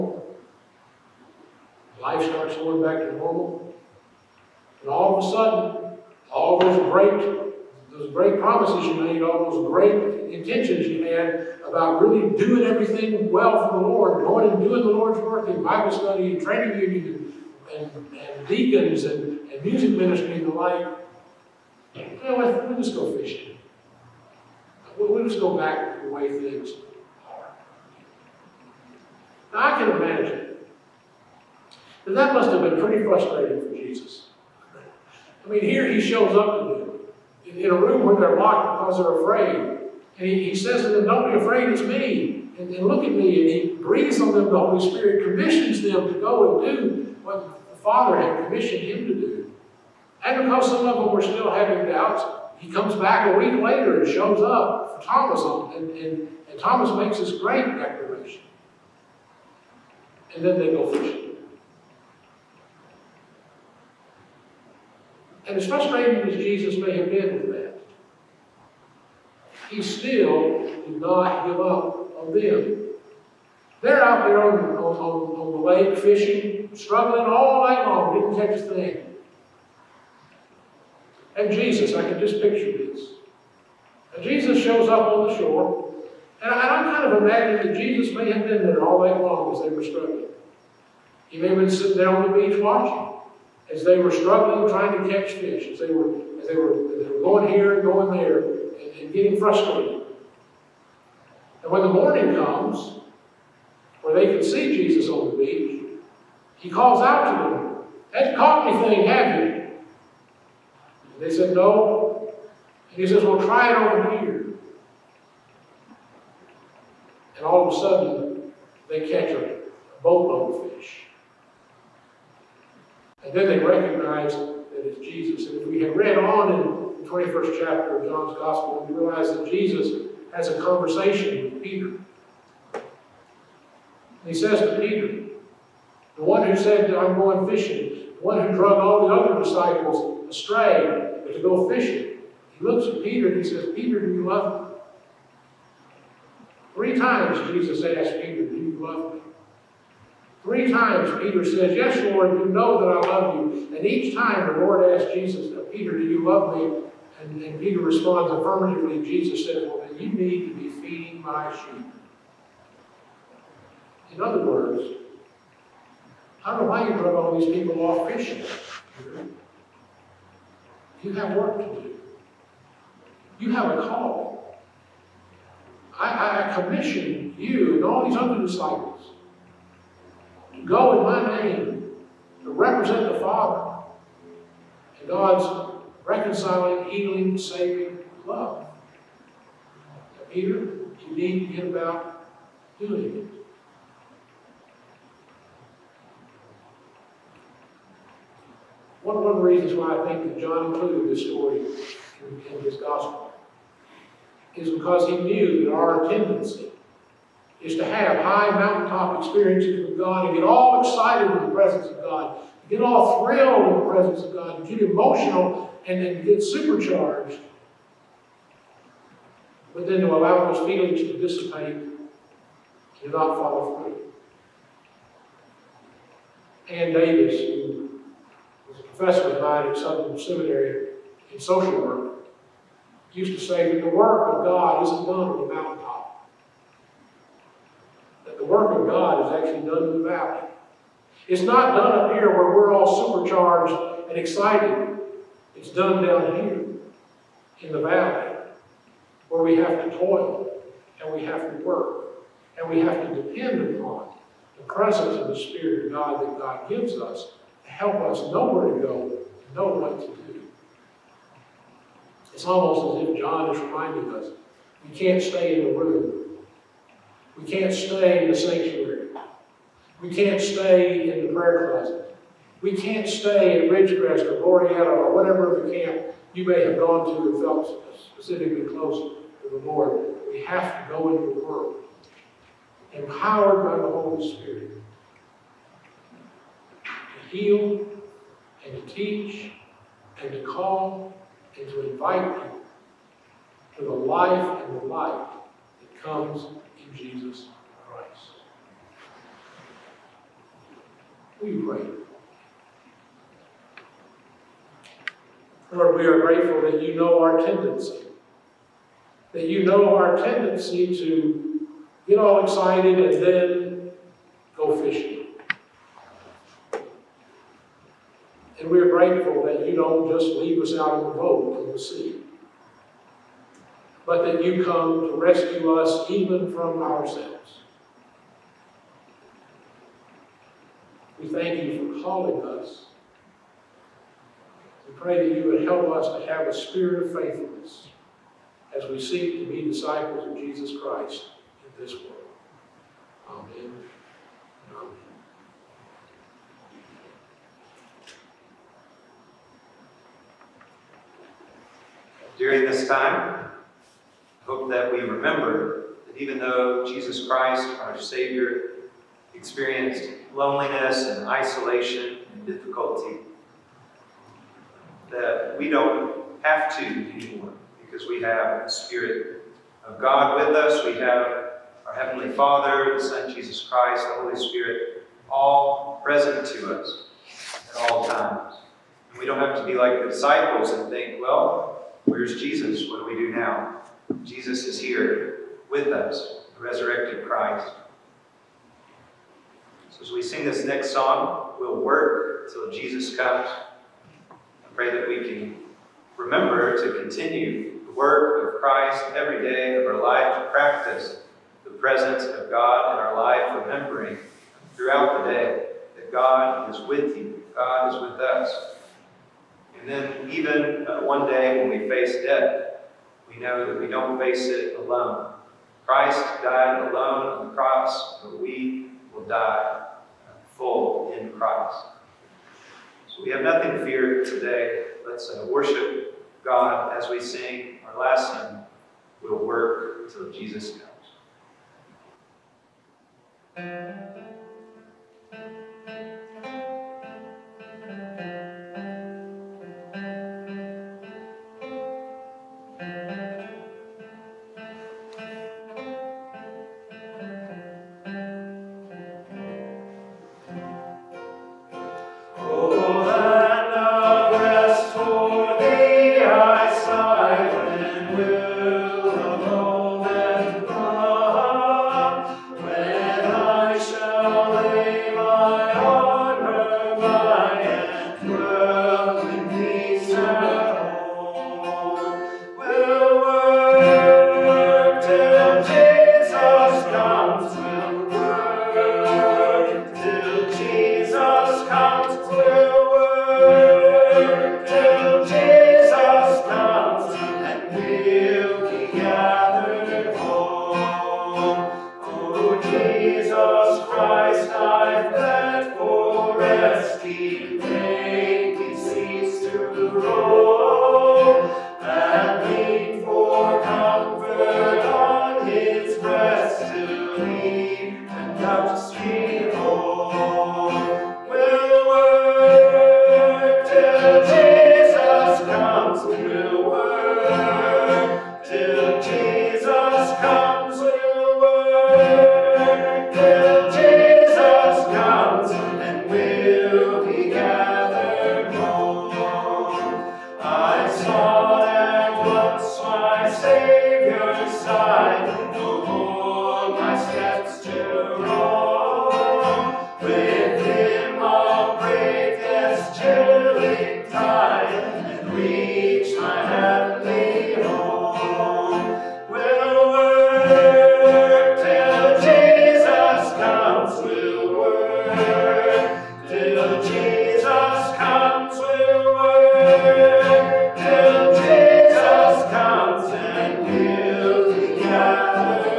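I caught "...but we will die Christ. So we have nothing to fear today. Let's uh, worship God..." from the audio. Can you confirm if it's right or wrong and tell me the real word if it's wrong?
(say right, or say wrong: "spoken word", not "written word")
right.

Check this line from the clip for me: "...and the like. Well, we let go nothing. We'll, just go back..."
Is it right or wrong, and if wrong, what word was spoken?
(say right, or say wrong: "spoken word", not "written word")
wrong: "fishing", not "nothing".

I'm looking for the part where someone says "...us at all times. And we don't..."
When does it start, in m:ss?
6:16.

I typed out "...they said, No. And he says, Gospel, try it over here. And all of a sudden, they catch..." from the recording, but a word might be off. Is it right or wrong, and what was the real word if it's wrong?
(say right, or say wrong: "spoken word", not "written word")
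wrong: "Well", not "Gospel".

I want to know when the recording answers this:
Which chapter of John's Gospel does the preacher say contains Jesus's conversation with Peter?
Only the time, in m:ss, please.
2:07.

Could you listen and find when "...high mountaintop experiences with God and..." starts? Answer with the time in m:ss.
3:28.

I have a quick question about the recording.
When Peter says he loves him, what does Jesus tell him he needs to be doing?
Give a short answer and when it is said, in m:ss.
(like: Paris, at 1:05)
Feeding my sheep, at 2:40.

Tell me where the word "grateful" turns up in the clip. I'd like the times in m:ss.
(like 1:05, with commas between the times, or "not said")
5:06, 5:18.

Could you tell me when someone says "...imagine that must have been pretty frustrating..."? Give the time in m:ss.
0:30.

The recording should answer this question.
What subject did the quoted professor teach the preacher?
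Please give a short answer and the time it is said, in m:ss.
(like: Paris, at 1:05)
Social work, at 3:51.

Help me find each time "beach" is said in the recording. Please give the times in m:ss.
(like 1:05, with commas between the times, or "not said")
1:32, 1:45.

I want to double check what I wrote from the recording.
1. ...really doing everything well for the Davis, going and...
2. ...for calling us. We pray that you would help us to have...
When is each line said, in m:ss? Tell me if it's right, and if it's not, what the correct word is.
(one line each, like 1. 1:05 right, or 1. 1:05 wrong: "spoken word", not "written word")
1. 0:12 wrong: "Lord", not "Davis"
2. 5:31 right.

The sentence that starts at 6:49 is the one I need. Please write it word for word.
And then even uh, one day when we face death, we know that we don't face it alone.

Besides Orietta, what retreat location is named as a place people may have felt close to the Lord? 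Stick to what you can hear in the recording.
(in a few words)
Ridgecrest.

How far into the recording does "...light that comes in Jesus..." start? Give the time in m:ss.
4:54.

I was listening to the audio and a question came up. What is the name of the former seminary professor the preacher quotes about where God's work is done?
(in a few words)
Anne Davis.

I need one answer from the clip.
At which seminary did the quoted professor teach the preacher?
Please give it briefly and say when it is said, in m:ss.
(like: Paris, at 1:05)
Southern Seminary, at 3:49.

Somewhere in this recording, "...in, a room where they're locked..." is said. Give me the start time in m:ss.
0:37.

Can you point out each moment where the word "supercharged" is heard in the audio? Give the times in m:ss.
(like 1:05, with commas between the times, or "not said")
3:36, 4:03.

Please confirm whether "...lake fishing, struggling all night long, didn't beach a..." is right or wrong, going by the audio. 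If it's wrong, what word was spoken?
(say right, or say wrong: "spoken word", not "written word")
wrong: "catch", not "beach".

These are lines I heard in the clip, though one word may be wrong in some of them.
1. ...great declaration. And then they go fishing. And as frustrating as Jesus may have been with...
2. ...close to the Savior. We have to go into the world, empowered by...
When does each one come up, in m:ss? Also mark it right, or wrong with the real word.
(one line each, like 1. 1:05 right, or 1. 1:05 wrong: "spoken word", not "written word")
1. 0:57 right
2. 4:38 wrong: "Lord", not "Savior".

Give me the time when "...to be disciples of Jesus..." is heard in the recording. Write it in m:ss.
5:39.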